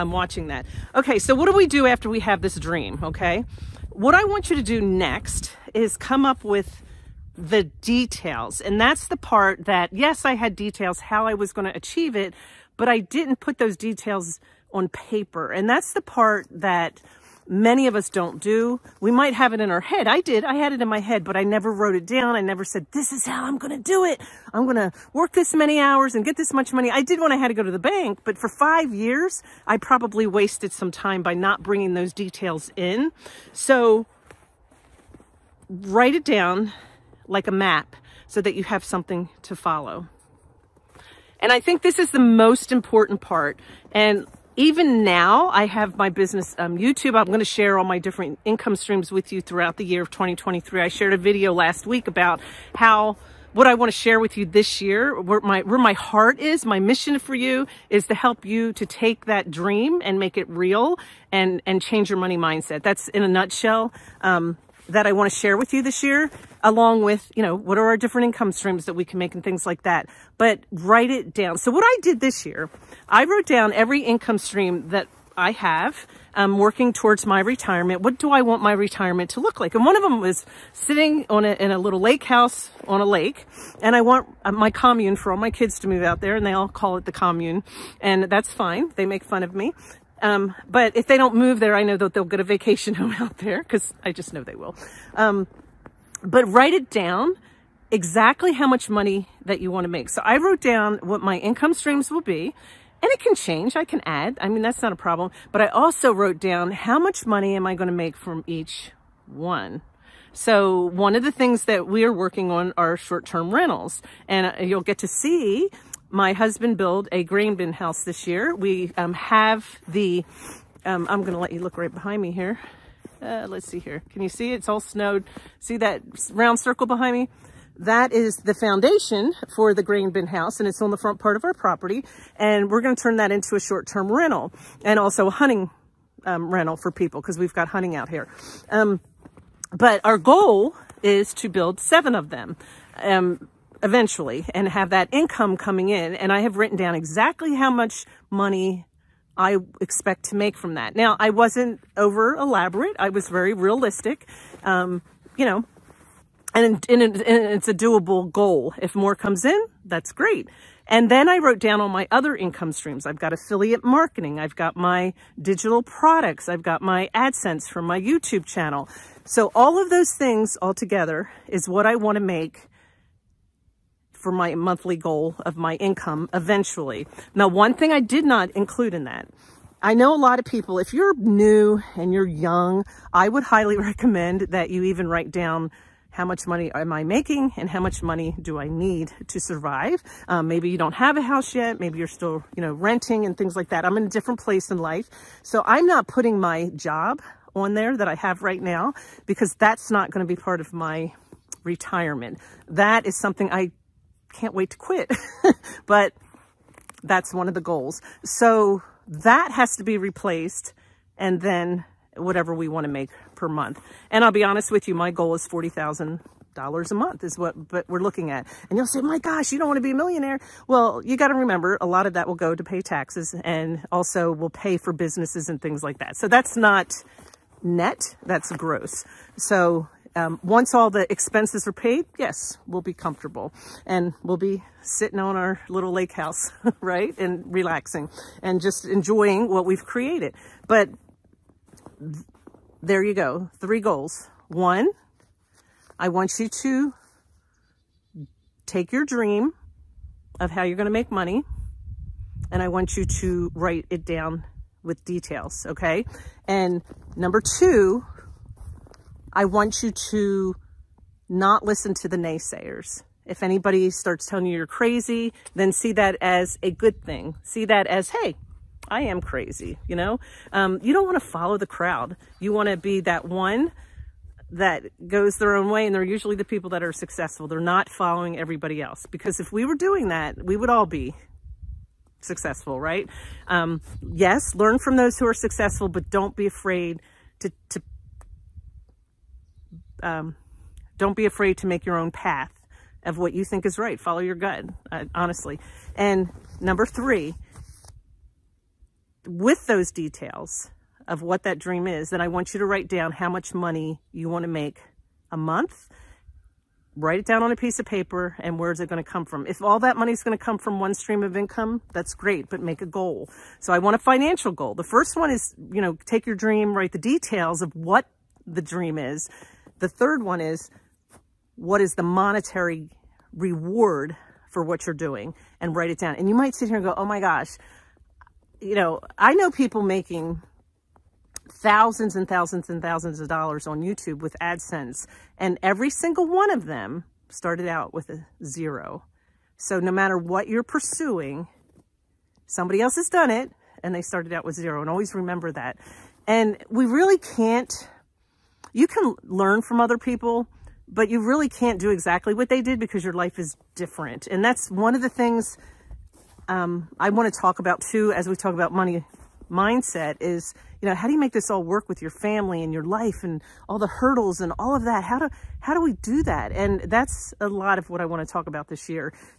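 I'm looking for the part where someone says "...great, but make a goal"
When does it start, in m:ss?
5:12.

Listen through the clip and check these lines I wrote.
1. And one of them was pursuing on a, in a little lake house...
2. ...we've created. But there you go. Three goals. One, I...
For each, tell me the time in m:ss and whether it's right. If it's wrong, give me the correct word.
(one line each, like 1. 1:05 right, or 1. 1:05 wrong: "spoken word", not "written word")
1. 1:19 wrong: "sitting", not "pursuing"
2. 3:59 right.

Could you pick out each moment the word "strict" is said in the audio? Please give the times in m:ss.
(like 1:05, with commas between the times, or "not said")
not said.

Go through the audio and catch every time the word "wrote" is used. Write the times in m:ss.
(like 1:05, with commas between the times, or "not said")
0:21, 1:13, 1:40, 1:46, 2:41.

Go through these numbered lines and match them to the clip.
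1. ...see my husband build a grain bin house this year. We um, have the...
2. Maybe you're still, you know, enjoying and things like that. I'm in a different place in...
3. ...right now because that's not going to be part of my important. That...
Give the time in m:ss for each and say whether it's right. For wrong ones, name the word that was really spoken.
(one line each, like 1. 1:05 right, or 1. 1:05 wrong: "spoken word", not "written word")
1. 1:55 right
2. 3:11 wrong: "renting", not "enjoying"
3. 3:18 wrong: "retirement", not "important".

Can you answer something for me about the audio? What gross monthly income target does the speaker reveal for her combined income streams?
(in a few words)
$40,000.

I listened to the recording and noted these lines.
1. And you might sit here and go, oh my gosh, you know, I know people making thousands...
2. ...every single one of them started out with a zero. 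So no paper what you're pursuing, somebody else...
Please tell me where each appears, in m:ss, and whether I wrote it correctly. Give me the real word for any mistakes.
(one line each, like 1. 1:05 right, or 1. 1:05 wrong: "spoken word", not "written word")
1. 5:26 right
2. 5:35 wrong: "matter", not "paper".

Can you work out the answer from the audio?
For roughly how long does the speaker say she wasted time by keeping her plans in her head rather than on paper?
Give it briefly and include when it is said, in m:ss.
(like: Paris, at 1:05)
5 years, at 0:28.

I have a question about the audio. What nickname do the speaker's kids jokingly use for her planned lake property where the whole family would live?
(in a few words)
The commune.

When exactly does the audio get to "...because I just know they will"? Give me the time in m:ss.
1:33.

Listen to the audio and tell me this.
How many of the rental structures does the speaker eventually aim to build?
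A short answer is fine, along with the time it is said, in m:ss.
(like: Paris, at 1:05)
7, at 2:21.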